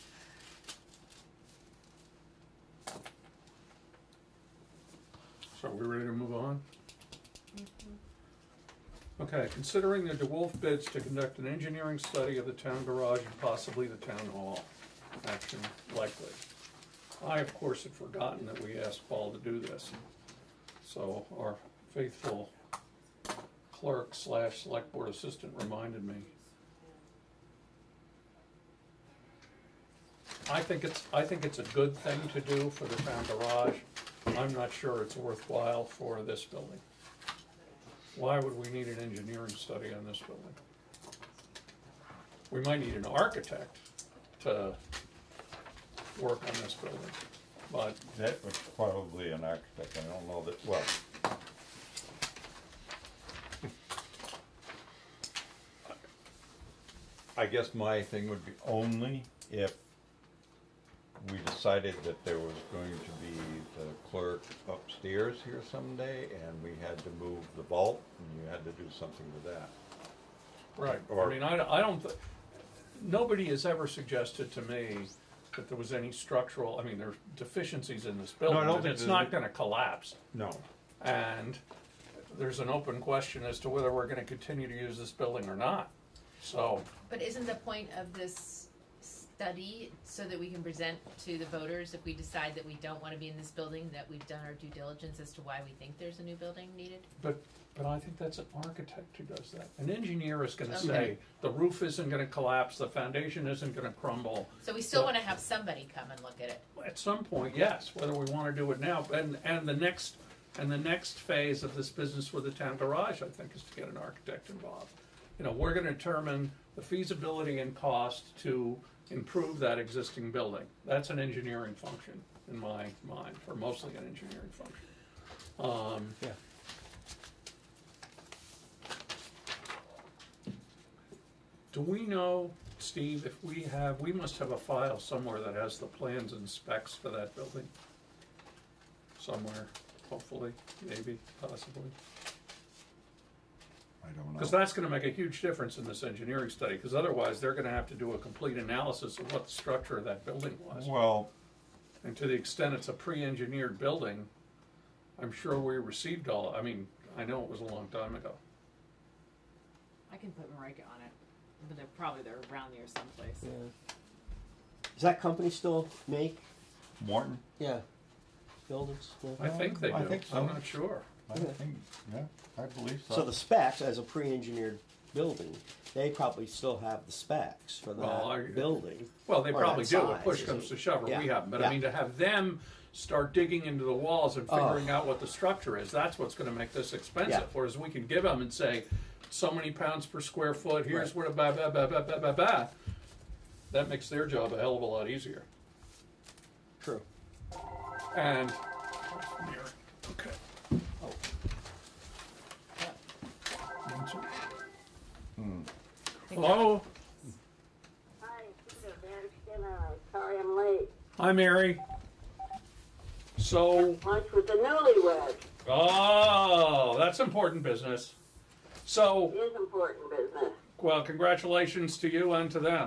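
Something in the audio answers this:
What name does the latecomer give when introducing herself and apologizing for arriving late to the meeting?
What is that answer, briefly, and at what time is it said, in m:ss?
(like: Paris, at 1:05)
Van Skinner, at 3:28.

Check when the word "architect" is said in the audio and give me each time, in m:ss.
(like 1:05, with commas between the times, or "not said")
0:43, 0:49, 1:38, 1:53.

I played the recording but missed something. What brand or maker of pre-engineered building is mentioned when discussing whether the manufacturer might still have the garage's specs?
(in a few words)
Morton.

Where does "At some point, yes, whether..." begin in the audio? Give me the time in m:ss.
1:46.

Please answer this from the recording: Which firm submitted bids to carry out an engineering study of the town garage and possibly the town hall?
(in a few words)
DeWolfe.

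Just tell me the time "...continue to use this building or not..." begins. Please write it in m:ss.
1:24.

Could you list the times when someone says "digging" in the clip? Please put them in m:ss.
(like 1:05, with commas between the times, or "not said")
3:03.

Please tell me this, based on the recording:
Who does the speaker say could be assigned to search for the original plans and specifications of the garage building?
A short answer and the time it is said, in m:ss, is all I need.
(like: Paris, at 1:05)
Marika, at 2:40.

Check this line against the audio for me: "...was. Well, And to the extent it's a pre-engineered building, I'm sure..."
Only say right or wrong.
right.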